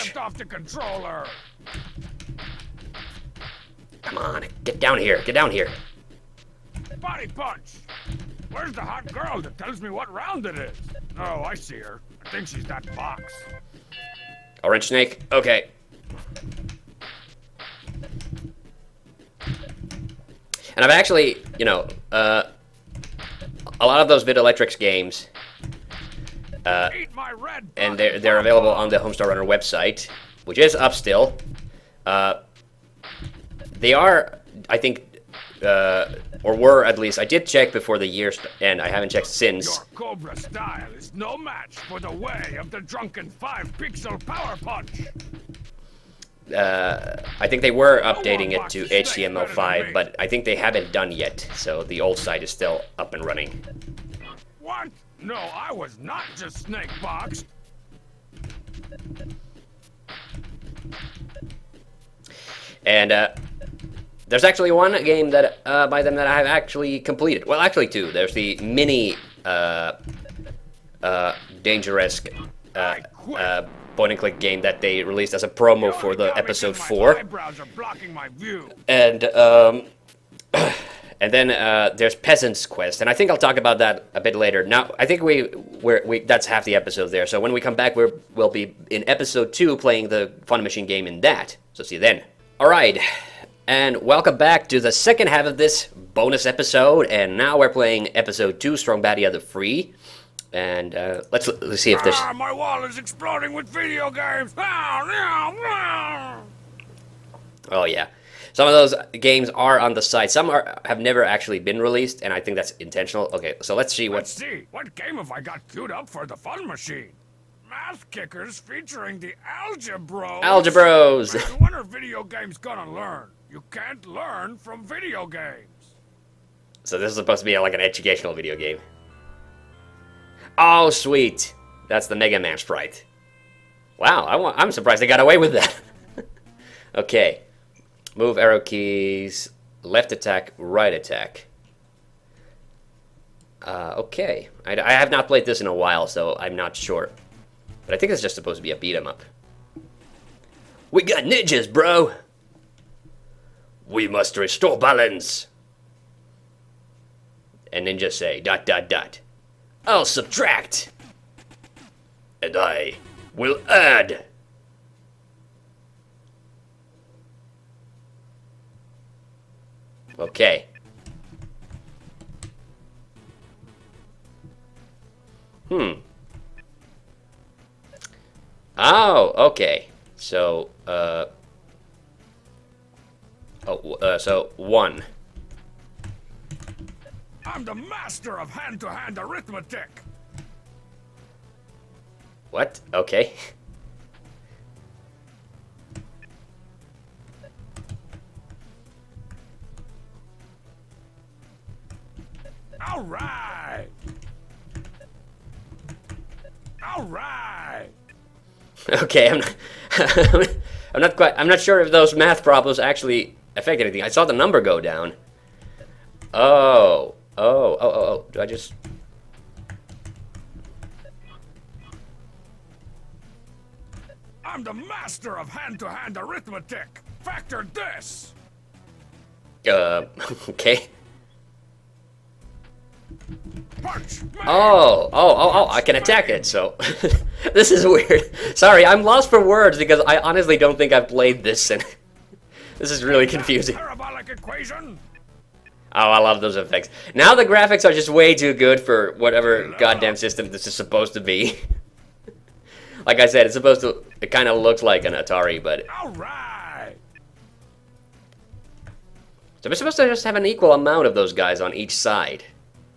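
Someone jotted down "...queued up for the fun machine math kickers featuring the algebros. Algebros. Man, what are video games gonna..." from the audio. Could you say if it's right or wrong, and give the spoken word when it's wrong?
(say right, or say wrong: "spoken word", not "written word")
right.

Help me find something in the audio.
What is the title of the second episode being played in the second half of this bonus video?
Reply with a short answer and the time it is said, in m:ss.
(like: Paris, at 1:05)
Strong Baddie of the Free, at 1:38.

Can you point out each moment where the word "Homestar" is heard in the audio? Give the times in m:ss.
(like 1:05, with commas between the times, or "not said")
0:28.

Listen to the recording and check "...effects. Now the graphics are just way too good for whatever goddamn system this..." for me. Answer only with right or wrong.
right.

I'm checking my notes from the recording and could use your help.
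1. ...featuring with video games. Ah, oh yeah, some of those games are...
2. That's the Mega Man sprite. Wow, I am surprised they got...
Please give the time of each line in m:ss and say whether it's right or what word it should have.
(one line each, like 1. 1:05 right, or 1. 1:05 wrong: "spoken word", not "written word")
1. 1:42 wrong: "exploding", not "featuring"
2. 2:11 right.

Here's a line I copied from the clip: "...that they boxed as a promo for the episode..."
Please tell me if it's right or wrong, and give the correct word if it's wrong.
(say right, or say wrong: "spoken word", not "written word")
wrong: "released", not "boxed".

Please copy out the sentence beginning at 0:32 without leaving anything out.
Uh, they are, I think, uh, or were at least.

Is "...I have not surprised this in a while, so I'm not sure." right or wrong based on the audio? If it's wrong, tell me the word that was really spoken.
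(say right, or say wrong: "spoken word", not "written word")
wrong: "played", not "surprised".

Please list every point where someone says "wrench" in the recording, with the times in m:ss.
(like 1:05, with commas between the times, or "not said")
0:14.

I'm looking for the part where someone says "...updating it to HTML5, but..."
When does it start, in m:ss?
0:48.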